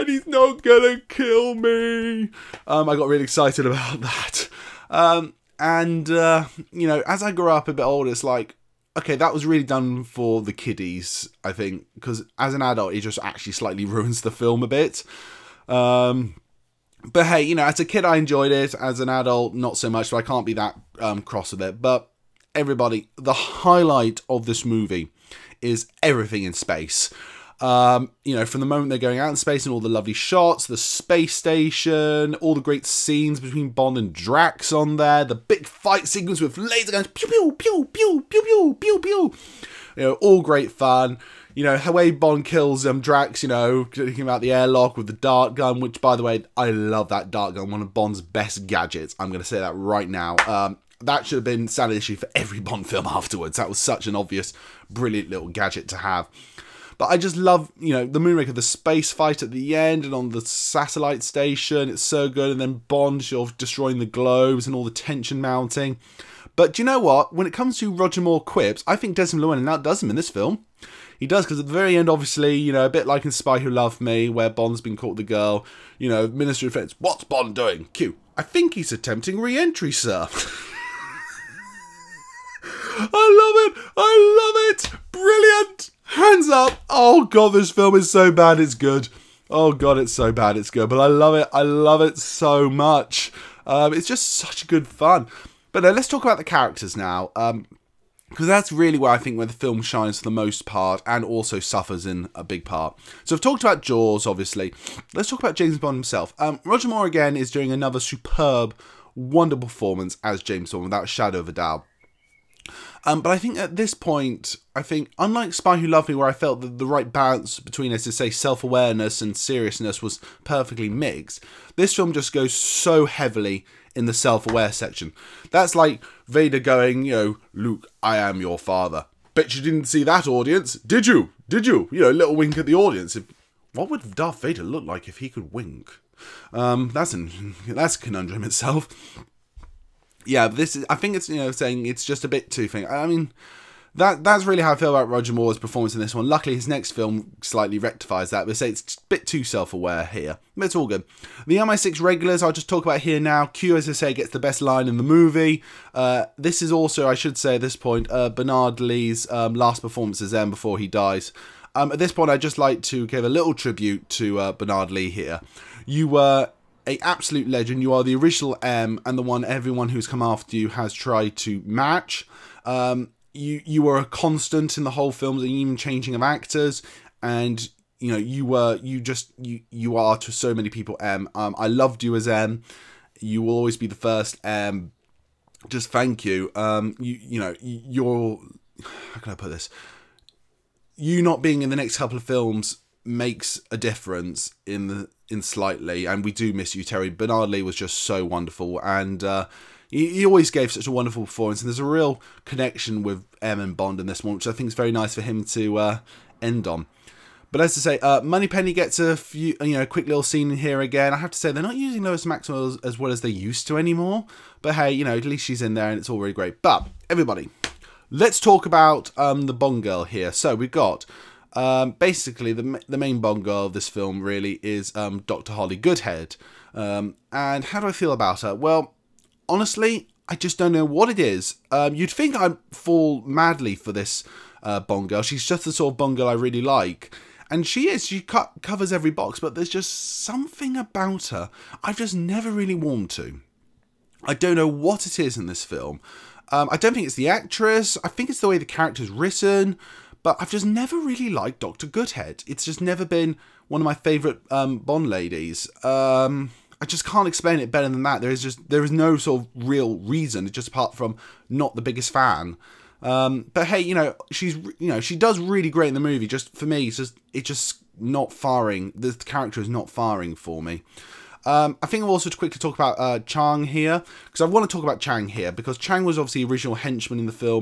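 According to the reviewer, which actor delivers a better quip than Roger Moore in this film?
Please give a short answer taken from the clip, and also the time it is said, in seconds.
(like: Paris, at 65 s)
Desmond Llewellyn, at 69 s.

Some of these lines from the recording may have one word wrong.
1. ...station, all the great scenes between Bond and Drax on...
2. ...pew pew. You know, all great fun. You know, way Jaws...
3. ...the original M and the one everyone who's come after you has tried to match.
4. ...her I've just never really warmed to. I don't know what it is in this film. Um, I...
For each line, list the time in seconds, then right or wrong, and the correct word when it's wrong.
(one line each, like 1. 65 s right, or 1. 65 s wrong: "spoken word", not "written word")
1. 31 s right
2. 38 s wrong: "Bond", not "Jaws"
3. 168 s right
4. 241 s right.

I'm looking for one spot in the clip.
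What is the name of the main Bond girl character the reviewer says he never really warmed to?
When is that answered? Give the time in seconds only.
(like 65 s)
225 s.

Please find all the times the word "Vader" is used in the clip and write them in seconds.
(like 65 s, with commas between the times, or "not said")
126 s, 134 s.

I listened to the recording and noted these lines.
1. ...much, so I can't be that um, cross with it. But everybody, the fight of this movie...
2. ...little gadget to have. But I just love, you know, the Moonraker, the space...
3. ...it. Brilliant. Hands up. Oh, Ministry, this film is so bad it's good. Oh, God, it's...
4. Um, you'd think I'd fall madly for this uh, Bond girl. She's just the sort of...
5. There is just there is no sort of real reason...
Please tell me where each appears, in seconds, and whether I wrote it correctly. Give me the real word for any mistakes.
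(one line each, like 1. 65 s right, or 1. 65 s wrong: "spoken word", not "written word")
1. 19 s wrong: "highlight", not "fight"
2. 55 s right
3. 84 s wrong: "God", not "Ministry"
4. 231 s right
5. 258 s right.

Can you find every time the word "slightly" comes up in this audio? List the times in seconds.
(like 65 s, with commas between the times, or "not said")
13 s, 147 s, 195 s.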